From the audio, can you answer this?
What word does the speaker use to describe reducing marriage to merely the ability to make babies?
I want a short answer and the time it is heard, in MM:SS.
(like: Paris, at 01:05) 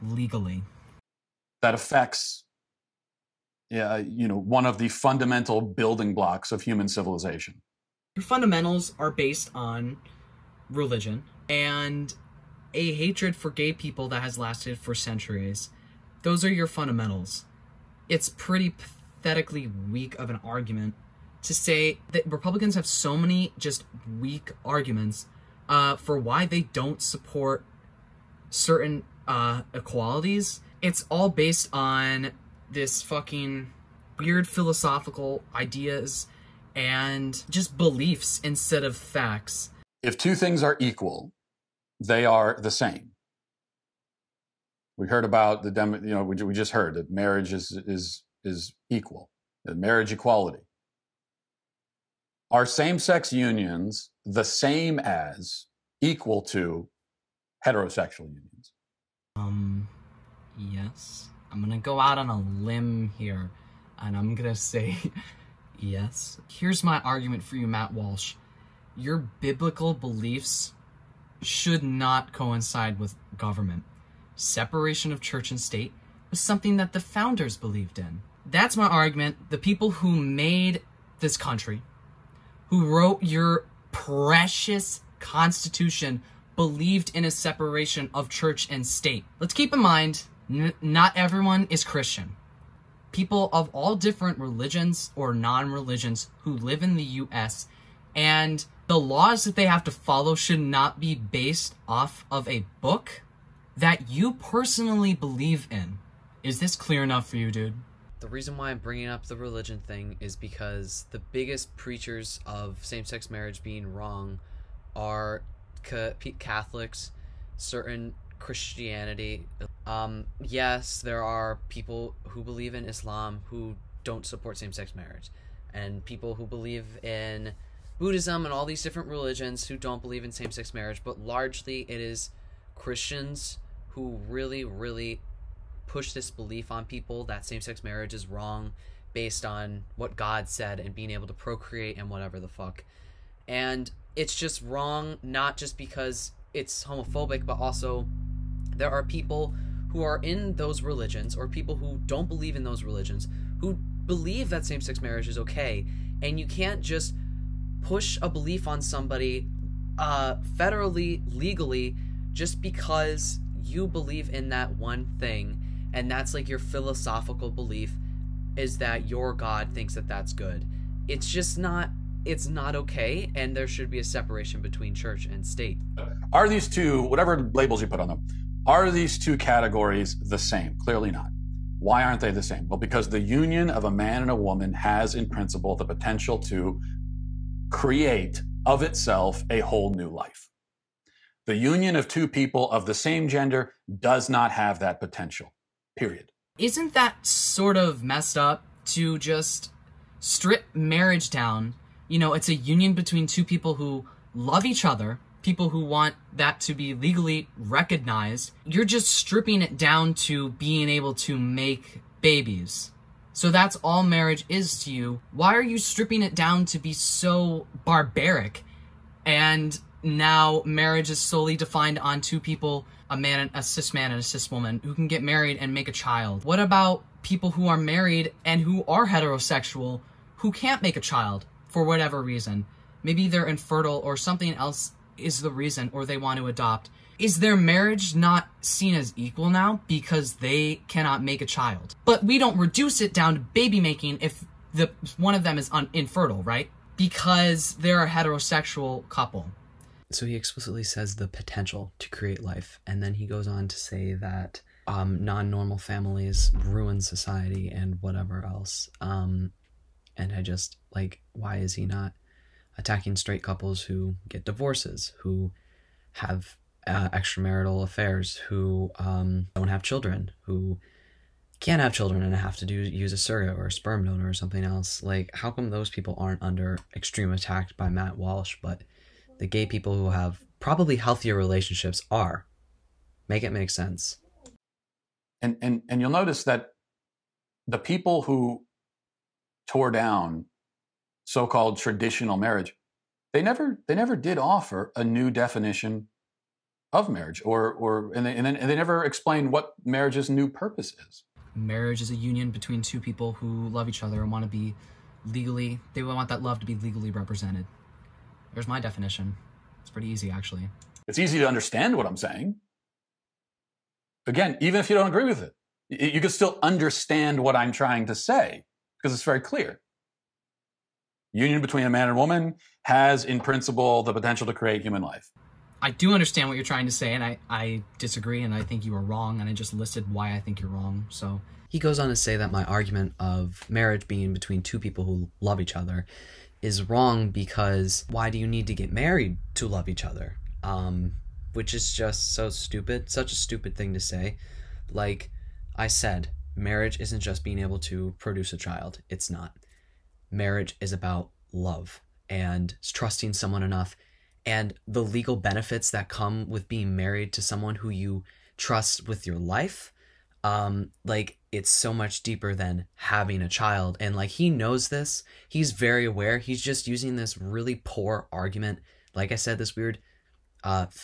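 Barbaric, at 03:37.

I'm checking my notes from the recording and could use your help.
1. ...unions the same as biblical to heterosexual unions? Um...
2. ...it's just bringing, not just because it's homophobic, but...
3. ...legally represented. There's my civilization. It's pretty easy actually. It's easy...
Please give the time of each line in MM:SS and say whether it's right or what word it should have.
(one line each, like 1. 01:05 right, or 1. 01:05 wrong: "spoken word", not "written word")
1. 00:53 wrong: "equal", not "biblical"
2. 02:24 wrong: "wrong", not "bringing"
3. 05:06 wrong: "definition", not "civilization".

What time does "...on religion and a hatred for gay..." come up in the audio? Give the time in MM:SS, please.
00:09.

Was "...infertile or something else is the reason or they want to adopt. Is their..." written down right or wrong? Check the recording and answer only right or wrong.
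right.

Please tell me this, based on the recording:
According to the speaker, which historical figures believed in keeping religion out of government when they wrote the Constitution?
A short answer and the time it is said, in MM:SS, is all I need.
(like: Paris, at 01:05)
The founders, at 01:17.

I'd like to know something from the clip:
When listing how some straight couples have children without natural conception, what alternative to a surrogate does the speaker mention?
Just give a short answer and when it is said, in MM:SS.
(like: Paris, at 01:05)
A sperm donor, at 04:33.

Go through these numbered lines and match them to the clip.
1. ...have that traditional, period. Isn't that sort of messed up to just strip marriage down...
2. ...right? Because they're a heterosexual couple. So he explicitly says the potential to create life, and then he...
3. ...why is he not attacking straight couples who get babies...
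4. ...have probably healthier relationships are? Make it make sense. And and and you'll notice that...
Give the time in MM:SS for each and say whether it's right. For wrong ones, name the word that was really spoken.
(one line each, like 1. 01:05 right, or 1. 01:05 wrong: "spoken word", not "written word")
1. 03:14 wrong: "potential", not "traditional"
2. 04:06 right
3. 04:21 wrong: "divorces", not "babies"
4. 04:40 right.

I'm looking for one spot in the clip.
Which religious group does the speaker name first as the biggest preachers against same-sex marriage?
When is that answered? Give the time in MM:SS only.
01:56.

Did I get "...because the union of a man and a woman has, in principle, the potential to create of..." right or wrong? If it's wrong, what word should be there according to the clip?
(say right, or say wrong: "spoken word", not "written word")
right.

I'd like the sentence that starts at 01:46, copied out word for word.
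Is this clear enough for you, dude?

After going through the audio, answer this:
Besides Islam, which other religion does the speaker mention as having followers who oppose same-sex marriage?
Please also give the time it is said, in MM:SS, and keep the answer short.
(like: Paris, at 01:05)
Buddhism, at 02:07.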